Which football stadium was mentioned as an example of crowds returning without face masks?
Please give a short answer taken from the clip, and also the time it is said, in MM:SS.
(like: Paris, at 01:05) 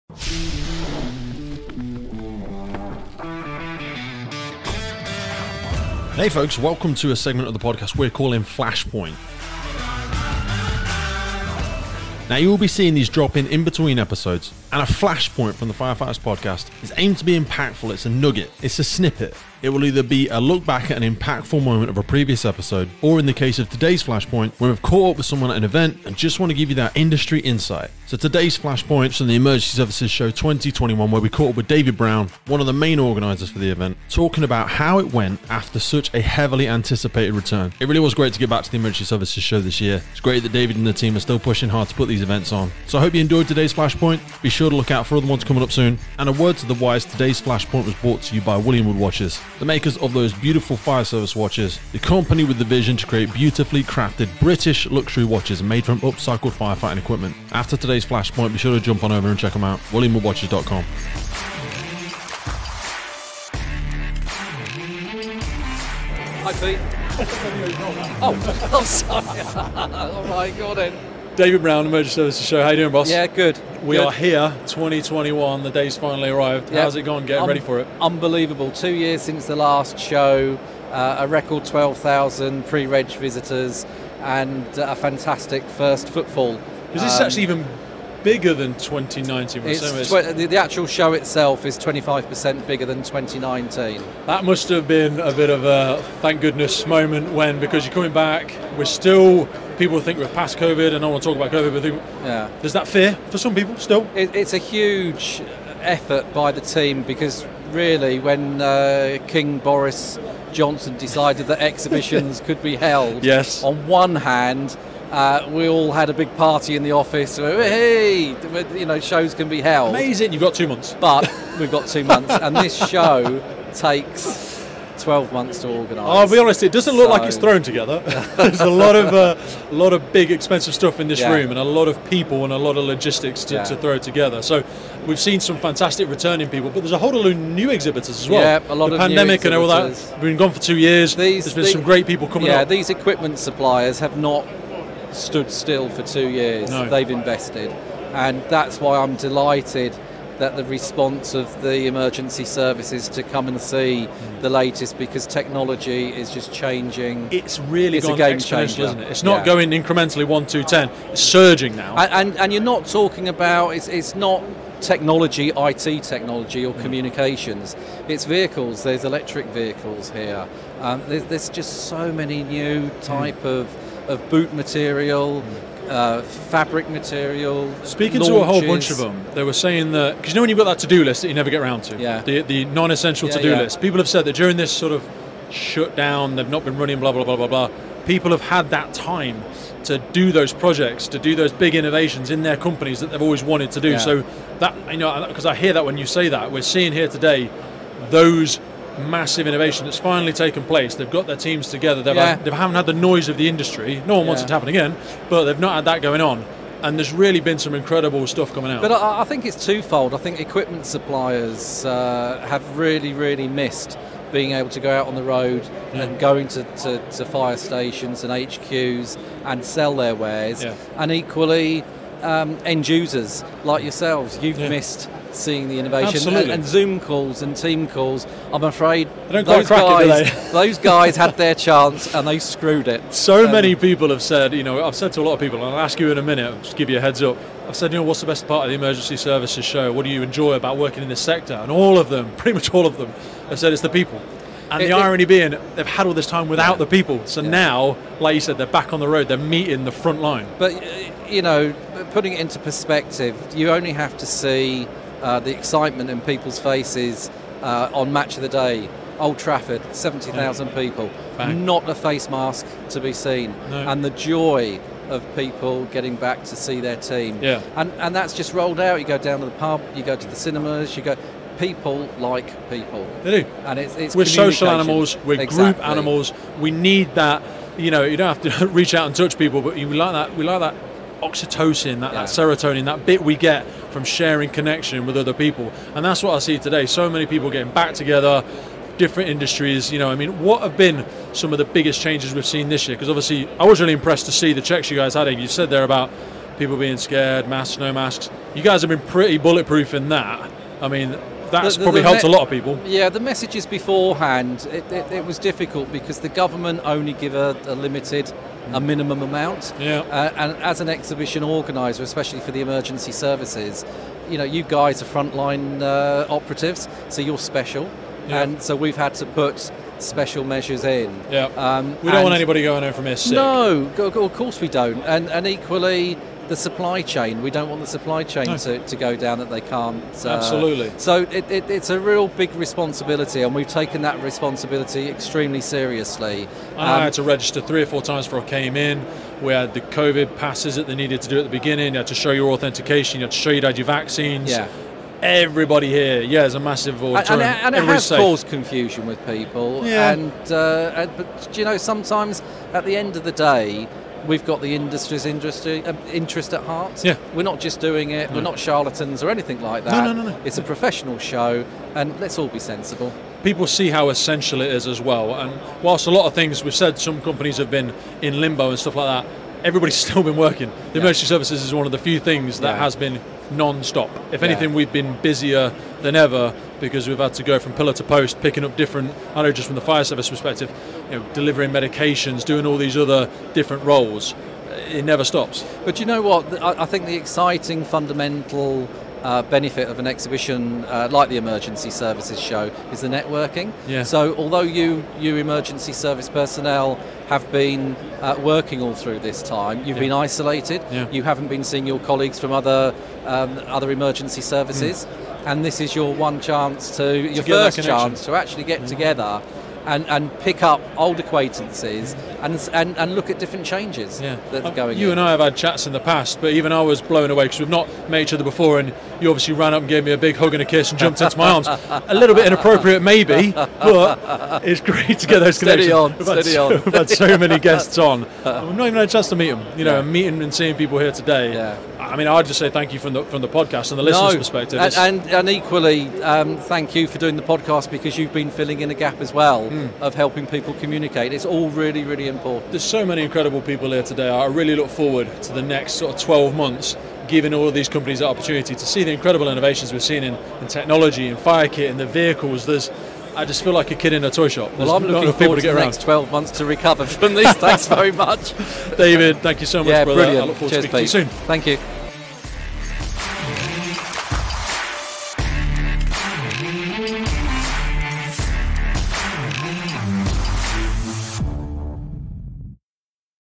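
Old Trafford, at 04:19.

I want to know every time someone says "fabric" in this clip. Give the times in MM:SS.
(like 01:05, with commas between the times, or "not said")
02:56.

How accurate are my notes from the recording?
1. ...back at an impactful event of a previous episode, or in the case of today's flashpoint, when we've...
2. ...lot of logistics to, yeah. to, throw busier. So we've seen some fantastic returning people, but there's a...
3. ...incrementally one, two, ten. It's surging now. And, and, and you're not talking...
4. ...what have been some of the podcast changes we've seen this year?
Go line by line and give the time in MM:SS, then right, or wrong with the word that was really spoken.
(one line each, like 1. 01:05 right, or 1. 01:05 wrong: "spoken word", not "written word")
1. 00:20 wrong: "moment", not "event"
2. 02:12 wrong: "together", not "busier"
3. 02:39 right
4. 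04:50 wrong: "biggest", not "podcast".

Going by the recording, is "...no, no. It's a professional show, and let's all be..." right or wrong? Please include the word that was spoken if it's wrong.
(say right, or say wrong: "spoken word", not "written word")
right.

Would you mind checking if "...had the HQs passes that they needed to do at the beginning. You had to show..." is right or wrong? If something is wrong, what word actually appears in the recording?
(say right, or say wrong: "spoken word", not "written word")
wrong: "COVID", not "HQs".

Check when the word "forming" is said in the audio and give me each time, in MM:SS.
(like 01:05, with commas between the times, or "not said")
not said.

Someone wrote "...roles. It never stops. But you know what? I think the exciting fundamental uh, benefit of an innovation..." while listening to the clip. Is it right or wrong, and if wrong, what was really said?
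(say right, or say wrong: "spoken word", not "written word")
wrong: "exhibition", not "innovation".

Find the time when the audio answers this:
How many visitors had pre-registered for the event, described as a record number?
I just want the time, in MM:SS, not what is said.
01:21.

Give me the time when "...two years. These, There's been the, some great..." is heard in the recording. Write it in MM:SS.
02:20.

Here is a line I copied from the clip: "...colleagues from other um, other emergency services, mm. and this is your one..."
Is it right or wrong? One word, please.
right.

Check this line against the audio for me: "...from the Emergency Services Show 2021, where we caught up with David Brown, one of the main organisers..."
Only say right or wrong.
right.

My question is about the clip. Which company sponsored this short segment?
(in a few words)
William Wood Watches.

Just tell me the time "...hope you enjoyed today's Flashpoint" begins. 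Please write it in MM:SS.
00:43.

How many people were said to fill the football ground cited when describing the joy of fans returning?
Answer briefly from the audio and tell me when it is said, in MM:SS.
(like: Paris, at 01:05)
70,000, at 04:19.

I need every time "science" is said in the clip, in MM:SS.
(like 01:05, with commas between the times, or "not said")
not said.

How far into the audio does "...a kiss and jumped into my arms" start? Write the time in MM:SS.
07:00.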